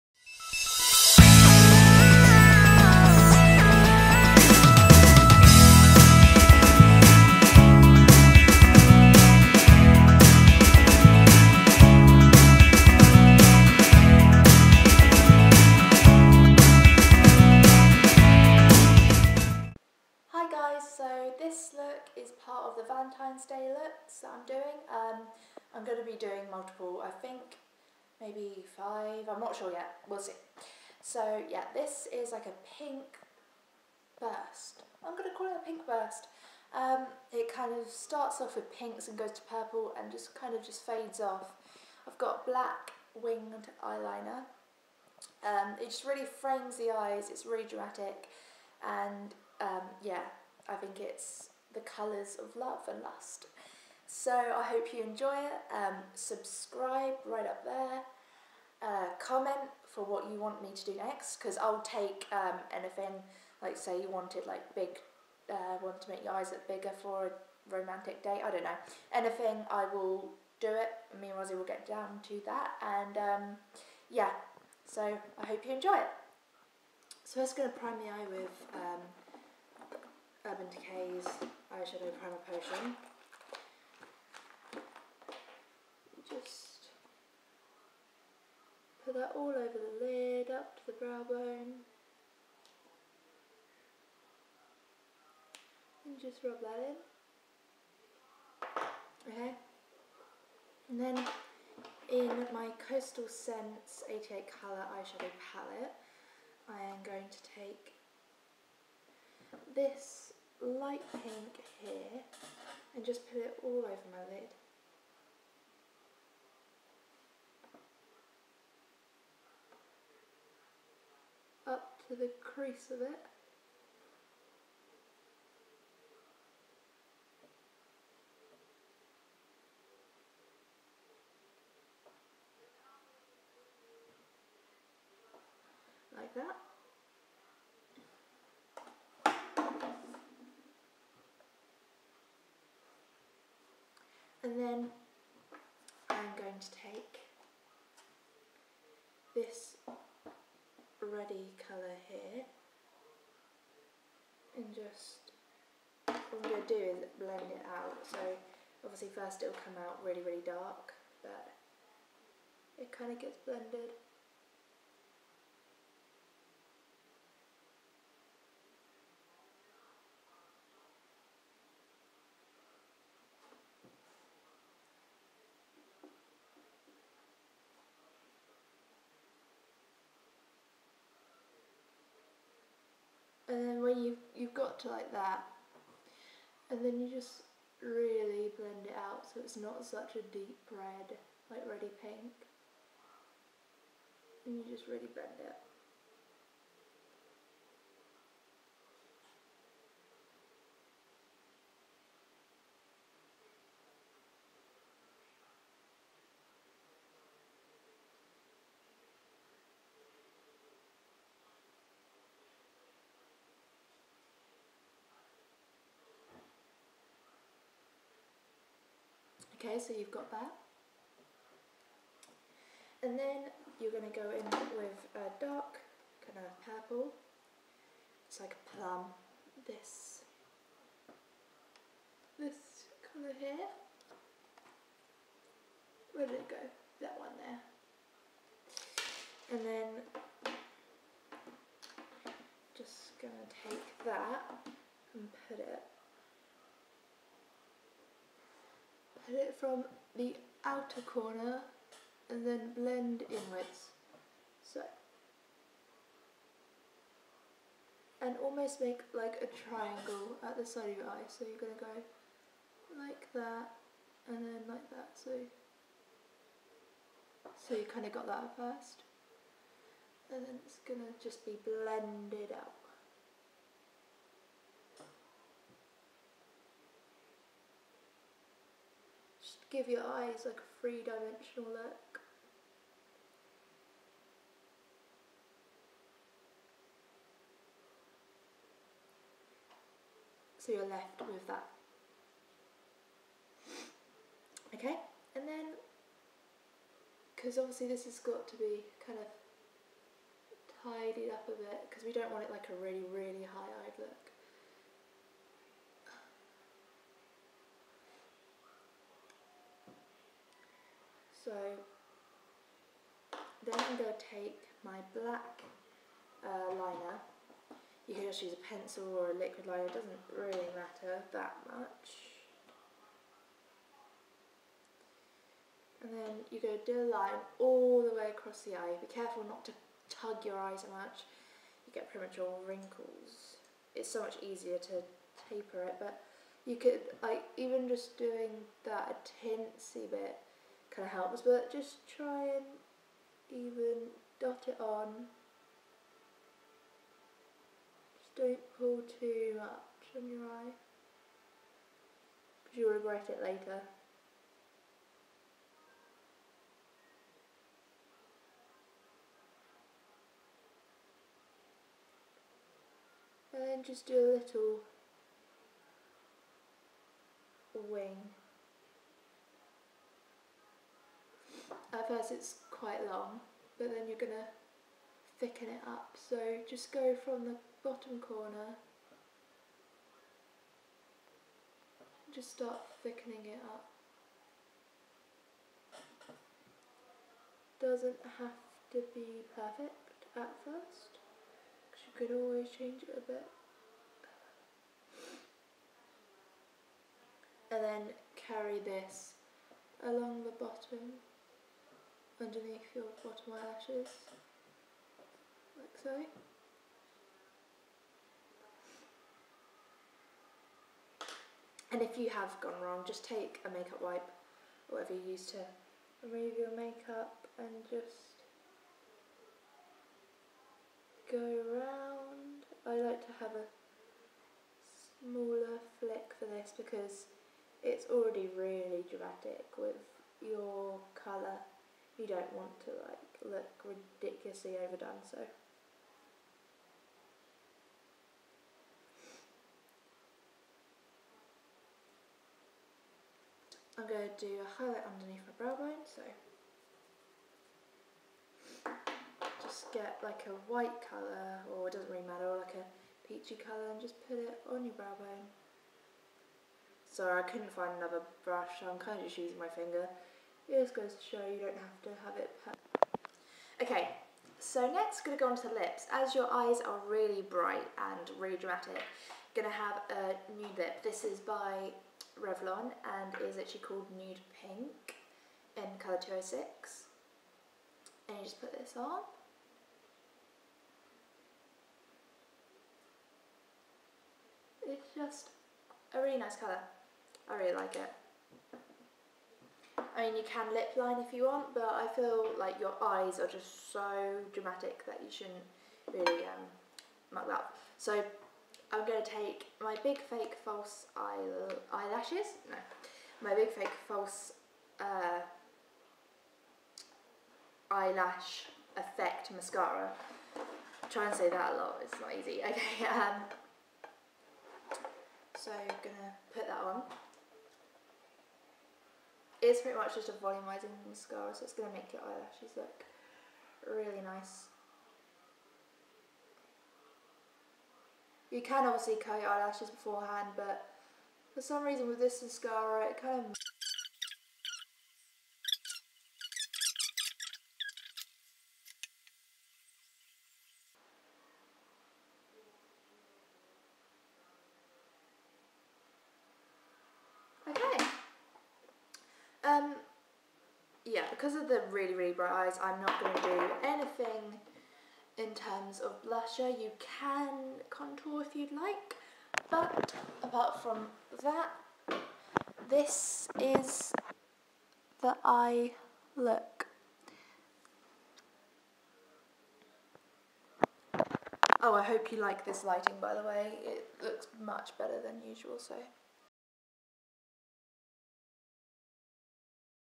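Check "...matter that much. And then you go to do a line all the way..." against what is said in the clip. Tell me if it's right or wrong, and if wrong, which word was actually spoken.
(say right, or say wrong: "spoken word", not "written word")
right.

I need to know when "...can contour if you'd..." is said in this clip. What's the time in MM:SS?
09:17.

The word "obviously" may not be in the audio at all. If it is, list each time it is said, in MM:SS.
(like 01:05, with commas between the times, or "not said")
02:38, 04:57, 08:48.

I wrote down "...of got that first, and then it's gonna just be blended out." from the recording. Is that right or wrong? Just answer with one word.
right.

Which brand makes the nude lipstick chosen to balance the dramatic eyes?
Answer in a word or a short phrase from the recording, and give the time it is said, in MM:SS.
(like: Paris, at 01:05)
Revlon, at 07:52.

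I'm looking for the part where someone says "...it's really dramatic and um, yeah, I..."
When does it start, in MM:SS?
00:47.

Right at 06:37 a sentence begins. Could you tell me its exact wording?
And then carry this along the bottom underneath your bottom eyelashes, like so.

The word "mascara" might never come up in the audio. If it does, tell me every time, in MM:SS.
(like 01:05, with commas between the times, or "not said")
08:29, 08:41, 08:52.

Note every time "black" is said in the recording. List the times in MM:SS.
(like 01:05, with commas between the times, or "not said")
00:42, 05:15.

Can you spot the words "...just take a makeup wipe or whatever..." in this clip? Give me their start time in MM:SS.
06:53.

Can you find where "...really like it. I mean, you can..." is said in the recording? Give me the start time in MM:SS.
08:07.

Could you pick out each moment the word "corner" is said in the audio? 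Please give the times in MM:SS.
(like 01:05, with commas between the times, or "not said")
04:11, 06:18.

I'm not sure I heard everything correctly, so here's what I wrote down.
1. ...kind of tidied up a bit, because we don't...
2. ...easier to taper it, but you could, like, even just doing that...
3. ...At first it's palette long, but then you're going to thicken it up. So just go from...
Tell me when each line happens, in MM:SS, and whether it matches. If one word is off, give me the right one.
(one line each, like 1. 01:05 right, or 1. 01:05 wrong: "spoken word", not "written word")
1. 04:59 right
2. 05:34 right
3. 06:11 wrong: "quite", not "palette".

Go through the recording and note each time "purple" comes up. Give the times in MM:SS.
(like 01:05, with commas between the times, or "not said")
00:39, 03:46.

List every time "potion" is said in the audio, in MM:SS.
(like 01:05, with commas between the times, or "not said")
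01:22.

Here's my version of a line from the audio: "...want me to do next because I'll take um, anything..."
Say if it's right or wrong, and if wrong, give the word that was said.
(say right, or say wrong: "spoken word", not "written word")
right.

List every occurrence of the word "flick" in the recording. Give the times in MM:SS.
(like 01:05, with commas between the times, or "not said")
07:05.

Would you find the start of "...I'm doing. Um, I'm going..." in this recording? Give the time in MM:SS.
00:24.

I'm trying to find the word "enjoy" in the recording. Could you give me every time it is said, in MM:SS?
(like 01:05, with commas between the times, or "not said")
00:55, 01:15.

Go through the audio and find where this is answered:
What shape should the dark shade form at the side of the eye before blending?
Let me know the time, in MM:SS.
04:19.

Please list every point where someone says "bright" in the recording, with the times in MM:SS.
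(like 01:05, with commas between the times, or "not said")
07:47, 09:12.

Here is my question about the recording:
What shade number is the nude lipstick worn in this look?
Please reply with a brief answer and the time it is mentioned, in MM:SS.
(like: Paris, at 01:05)
206, at 07:56.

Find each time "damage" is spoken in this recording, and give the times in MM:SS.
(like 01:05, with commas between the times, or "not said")
not said.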